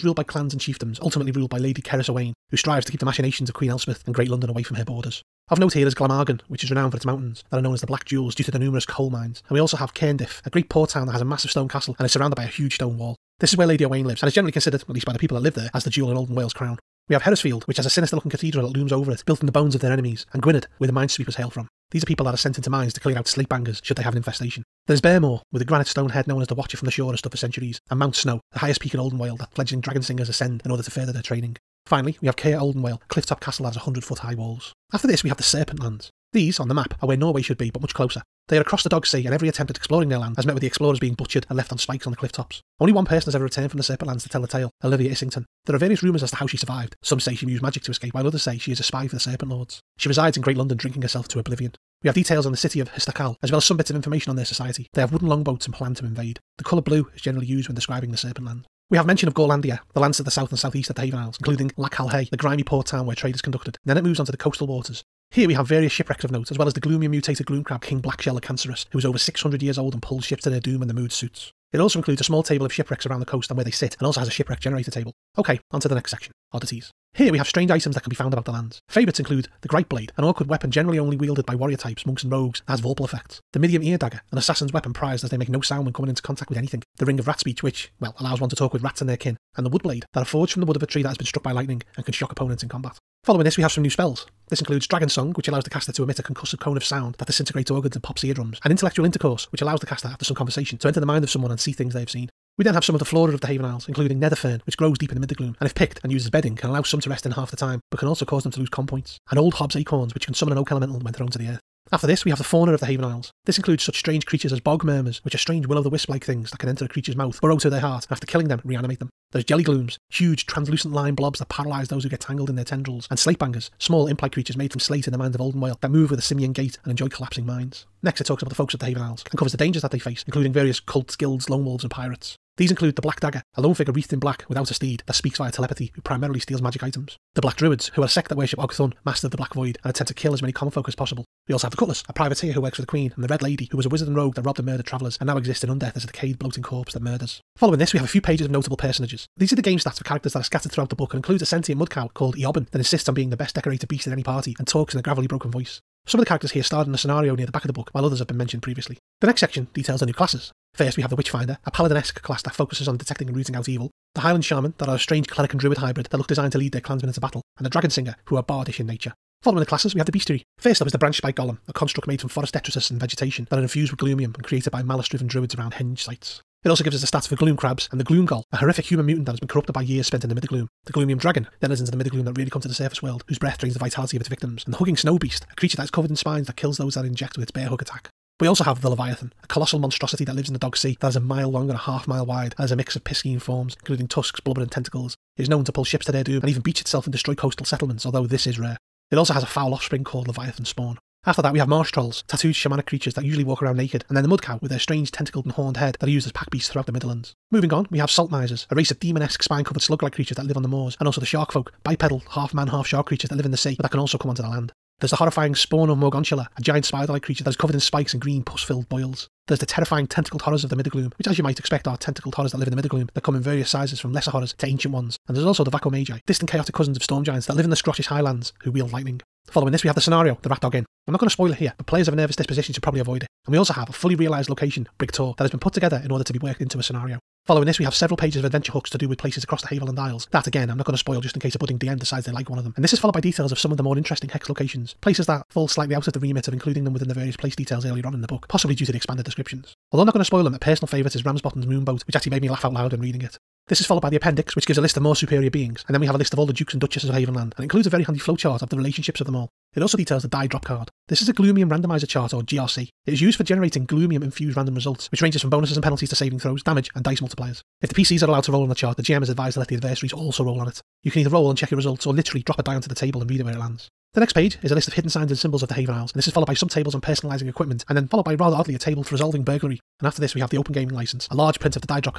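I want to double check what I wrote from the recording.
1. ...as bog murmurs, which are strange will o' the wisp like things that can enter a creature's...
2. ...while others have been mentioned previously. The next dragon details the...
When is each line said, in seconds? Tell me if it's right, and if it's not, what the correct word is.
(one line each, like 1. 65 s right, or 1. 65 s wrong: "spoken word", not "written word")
1. 114 s right
2. 157 s wrong: "section", not "dragon".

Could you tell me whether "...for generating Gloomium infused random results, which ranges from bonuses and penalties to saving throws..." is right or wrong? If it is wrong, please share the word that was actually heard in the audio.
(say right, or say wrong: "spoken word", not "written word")
right.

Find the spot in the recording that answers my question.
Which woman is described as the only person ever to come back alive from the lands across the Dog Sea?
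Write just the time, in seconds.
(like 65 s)
44 s.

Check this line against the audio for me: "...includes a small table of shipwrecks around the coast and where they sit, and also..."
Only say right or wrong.
right.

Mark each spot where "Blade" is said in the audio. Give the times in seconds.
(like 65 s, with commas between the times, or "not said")
79 s, 89 s.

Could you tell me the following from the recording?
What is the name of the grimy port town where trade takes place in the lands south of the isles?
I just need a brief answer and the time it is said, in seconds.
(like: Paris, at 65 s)
Lac Calhei, at 61 s.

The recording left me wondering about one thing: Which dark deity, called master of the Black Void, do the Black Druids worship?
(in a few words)
Ogthun.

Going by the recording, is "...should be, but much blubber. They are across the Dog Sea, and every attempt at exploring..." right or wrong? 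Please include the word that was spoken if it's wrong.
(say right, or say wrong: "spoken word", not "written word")
wrong: "closer", not "blubber".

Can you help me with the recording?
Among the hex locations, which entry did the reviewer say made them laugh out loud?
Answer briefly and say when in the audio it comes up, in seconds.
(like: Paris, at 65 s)
Ramsbottom's Moonboat, at 251 s.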